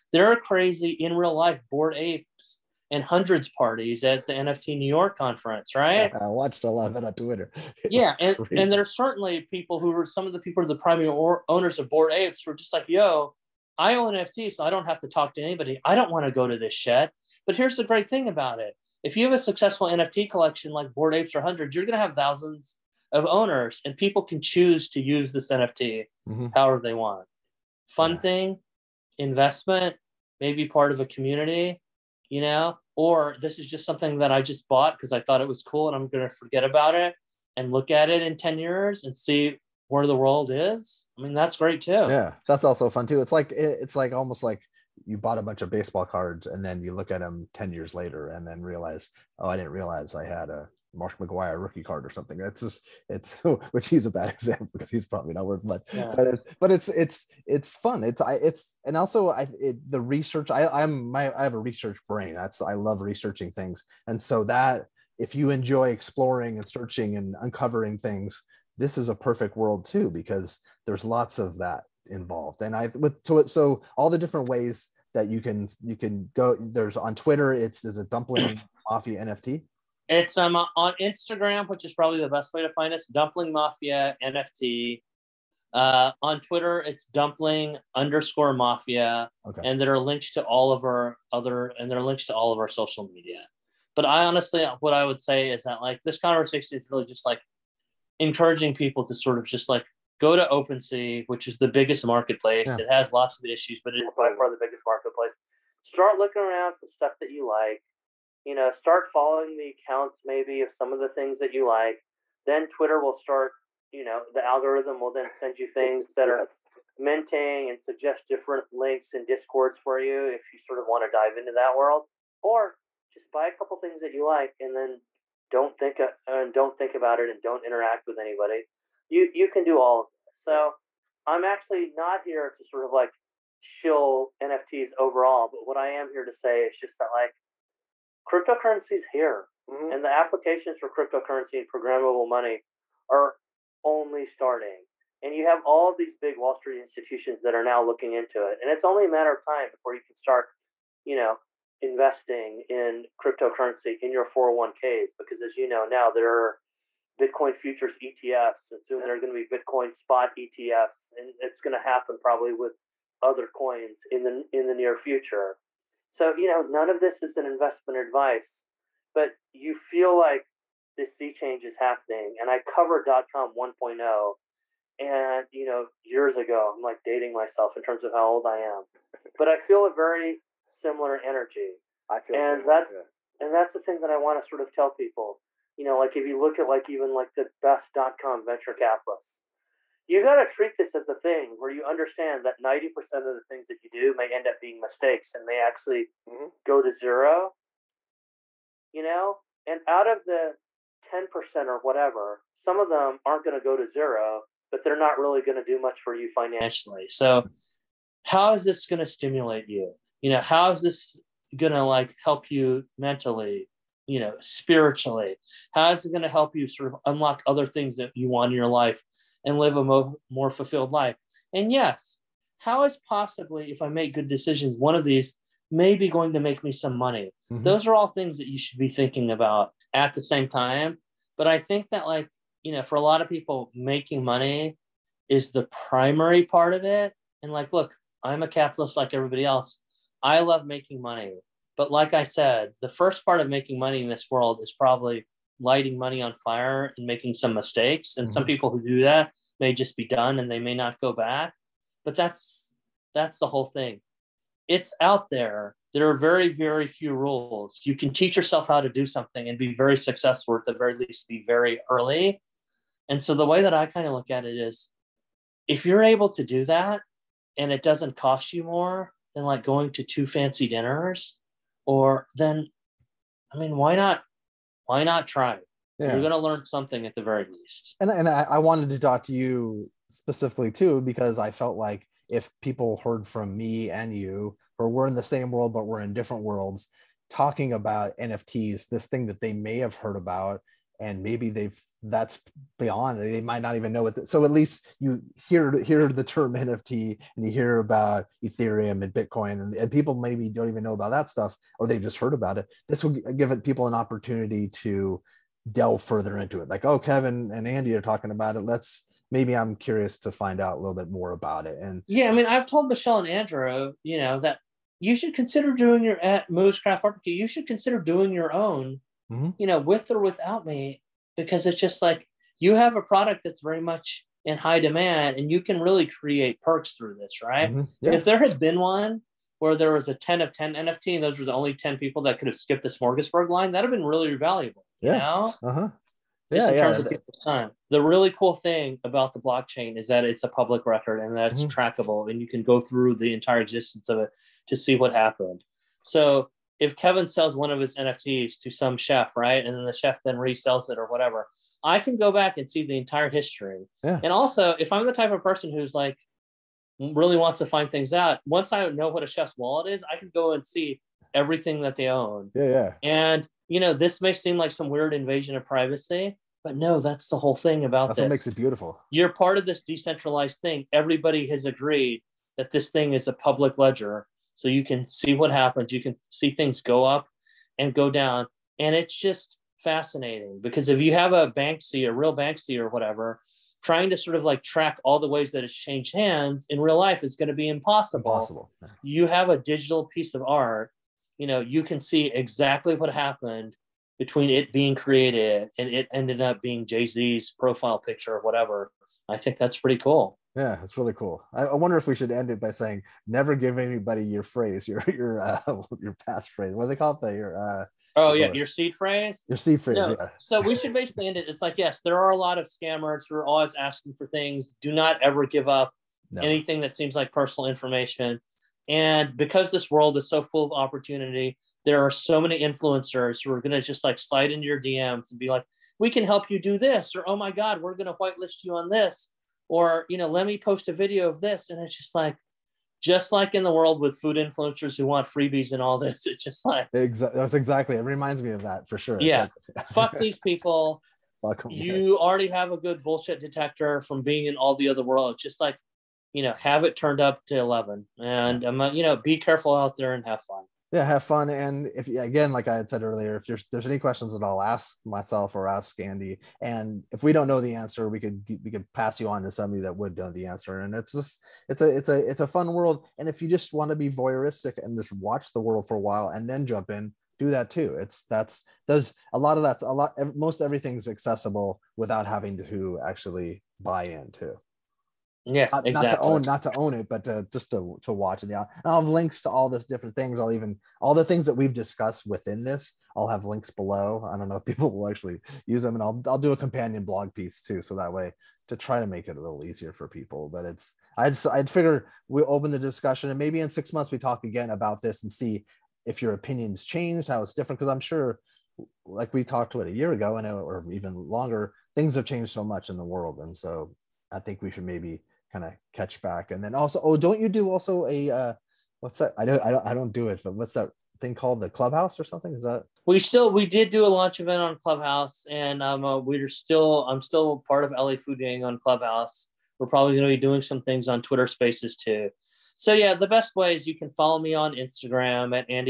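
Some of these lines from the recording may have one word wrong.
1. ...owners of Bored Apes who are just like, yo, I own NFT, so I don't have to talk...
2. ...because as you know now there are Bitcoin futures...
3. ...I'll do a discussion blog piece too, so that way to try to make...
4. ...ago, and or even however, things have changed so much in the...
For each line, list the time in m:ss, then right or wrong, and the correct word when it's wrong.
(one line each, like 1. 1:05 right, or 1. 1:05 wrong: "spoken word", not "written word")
1. 0:11 right
2. 2:35 right
3. 8:06 wrong: "companion", not "discussion"
4. 8:20 wrong: "longer", not "however".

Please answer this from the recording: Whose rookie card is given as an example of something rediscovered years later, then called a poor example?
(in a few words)
Mark McGwire.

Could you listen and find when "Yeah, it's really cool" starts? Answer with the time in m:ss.
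6:40.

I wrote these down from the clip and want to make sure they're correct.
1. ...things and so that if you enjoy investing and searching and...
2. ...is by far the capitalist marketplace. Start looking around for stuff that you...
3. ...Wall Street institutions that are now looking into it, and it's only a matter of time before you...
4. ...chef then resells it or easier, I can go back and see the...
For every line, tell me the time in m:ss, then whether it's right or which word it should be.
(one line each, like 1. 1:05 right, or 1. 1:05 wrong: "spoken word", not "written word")
1. 1:03 wrong: "exploring", not "investing"
2. 1:44 wrong: "biggest", not "capitalist"
3. 2:26 right
4. 5:49 wrong: "whatever", not "easier".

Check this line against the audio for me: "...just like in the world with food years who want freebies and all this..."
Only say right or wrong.
wrong.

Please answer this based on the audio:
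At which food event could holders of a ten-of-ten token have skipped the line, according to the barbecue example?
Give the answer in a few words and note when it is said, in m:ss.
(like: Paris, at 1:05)
Smorgasburg, at 5:32.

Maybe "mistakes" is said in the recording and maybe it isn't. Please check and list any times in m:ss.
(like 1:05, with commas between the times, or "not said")
3:14, 4:07.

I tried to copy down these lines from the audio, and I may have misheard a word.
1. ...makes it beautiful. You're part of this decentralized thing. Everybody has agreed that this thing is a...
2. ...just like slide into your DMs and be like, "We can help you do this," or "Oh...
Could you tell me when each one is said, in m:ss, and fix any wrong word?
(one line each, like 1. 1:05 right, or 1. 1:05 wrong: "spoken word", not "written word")
1. 6:08 right
2. 7:03 right.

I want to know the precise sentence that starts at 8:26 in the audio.
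And then also, oh, don't you do also a uh, what's that?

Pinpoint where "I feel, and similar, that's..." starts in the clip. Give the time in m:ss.
3:02.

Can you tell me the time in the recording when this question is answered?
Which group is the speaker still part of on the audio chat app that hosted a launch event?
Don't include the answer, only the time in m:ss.
8:37.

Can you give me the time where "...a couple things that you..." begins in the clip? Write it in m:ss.
2:03.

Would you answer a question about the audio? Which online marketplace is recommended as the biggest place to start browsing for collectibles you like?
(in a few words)
OpenSea.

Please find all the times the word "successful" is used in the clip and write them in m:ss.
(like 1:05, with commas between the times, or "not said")
0:19, 4:19.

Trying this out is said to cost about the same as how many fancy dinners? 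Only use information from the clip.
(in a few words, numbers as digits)
2.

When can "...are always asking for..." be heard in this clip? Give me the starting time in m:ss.
6:53.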